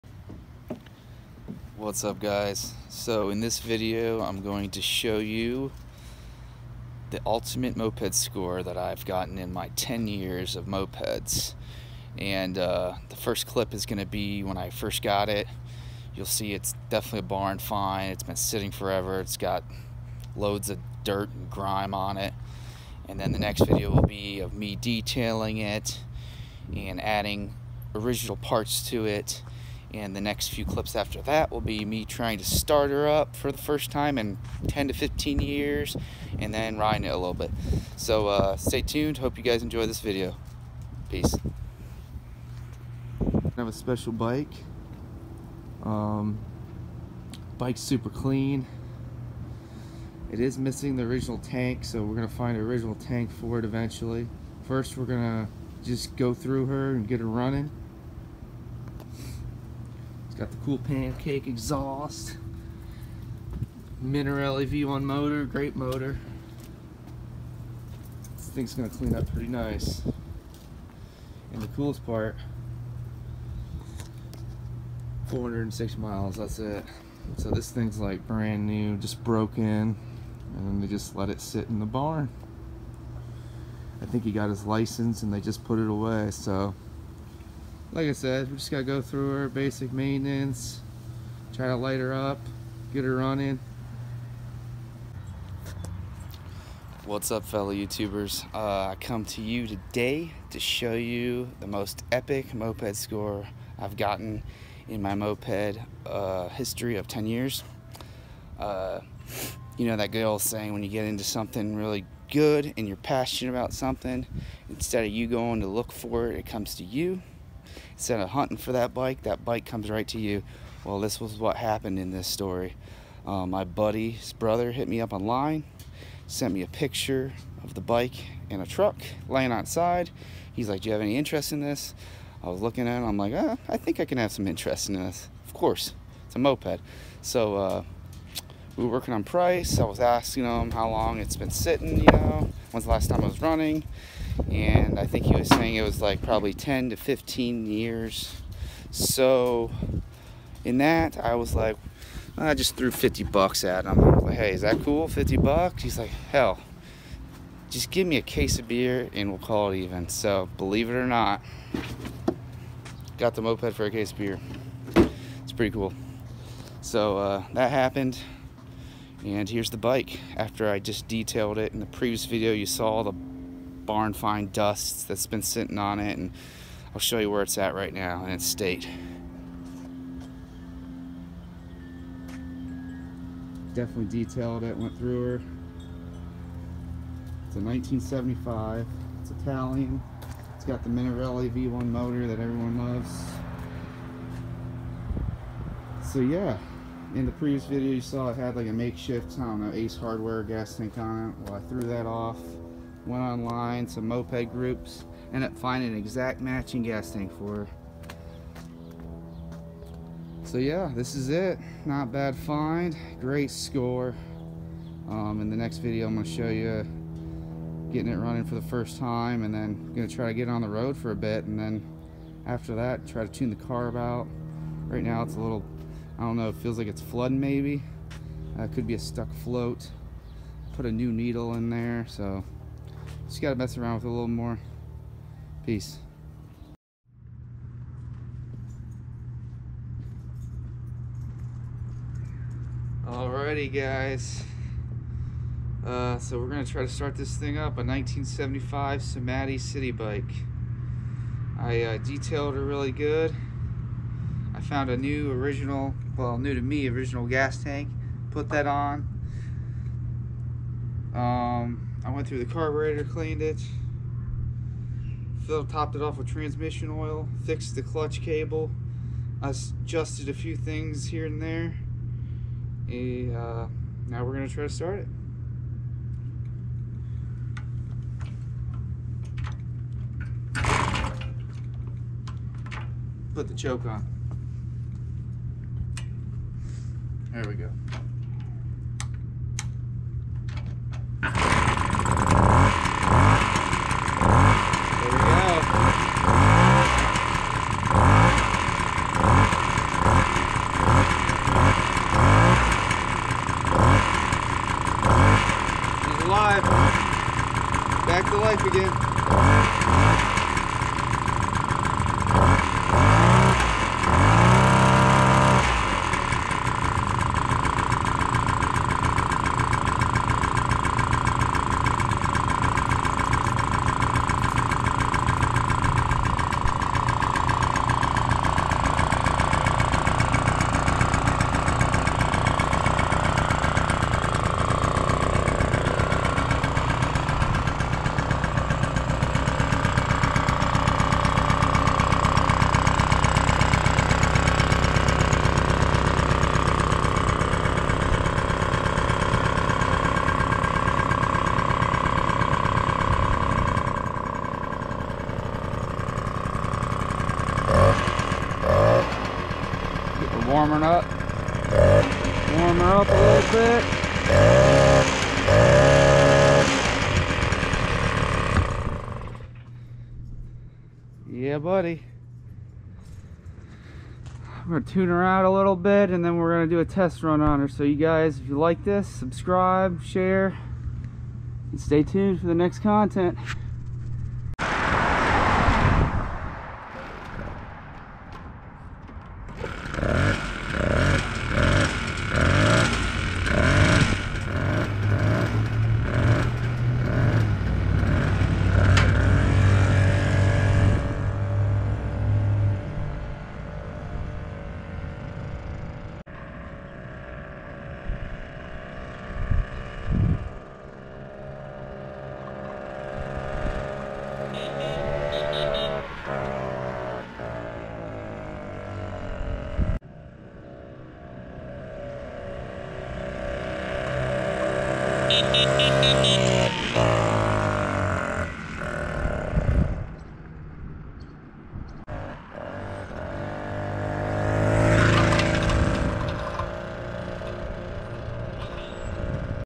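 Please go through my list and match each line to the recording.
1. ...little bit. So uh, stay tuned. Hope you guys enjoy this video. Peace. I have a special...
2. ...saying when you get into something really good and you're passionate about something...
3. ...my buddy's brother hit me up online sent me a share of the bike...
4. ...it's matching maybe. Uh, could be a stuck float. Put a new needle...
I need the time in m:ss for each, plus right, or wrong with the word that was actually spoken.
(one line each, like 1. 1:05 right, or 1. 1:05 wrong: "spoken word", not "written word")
1. 0:37 right
2. 1:50 right
3. 2:03 wrong: "picture", not "share"
4. 3:46 wrong: "flooding", not "matching".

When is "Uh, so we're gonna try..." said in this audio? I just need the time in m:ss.
4:05.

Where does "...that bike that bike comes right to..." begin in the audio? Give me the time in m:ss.
1:58.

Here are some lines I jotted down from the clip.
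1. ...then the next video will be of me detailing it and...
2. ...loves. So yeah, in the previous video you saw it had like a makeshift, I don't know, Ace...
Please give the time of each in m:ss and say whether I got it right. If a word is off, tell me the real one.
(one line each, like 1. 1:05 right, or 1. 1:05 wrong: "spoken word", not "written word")
1. 0:23 right
2. 3:12 right.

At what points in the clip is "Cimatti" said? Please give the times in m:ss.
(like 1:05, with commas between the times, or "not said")
4:09.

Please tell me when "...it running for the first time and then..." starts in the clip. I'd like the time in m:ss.
3:38.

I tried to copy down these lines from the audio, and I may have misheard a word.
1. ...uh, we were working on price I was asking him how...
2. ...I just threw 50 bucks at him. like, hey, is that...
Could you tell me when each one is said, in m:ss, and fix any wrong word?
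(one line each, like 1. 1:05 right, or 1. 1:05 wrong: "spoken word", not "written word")
1. 2:17 right
2. 2:32 right.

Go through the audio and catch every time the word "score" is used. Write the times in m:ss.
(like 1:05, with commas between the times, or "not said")
0:08, 1:42, 3:33.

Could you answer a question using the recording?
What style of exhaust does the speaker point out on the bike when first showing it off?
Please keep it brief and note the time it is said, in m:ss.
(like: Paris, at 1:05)
pancake exhaust, at 1:00.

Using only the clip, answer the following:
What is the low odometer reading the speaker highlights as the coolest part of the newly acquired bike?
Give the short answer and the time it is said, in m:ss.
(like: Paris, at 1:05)
406 miles, at 1:15.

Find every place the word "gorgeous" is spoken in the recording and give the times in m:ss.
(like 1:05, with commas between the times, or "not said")
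not said.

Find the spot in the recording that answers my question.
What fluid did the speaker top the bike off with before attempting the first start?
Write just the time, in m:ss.
4:26.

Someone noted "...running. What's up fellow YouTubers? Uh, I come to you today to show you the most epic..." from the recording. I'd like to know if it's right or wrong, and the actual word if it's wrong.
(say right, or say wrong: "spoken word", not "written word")
right.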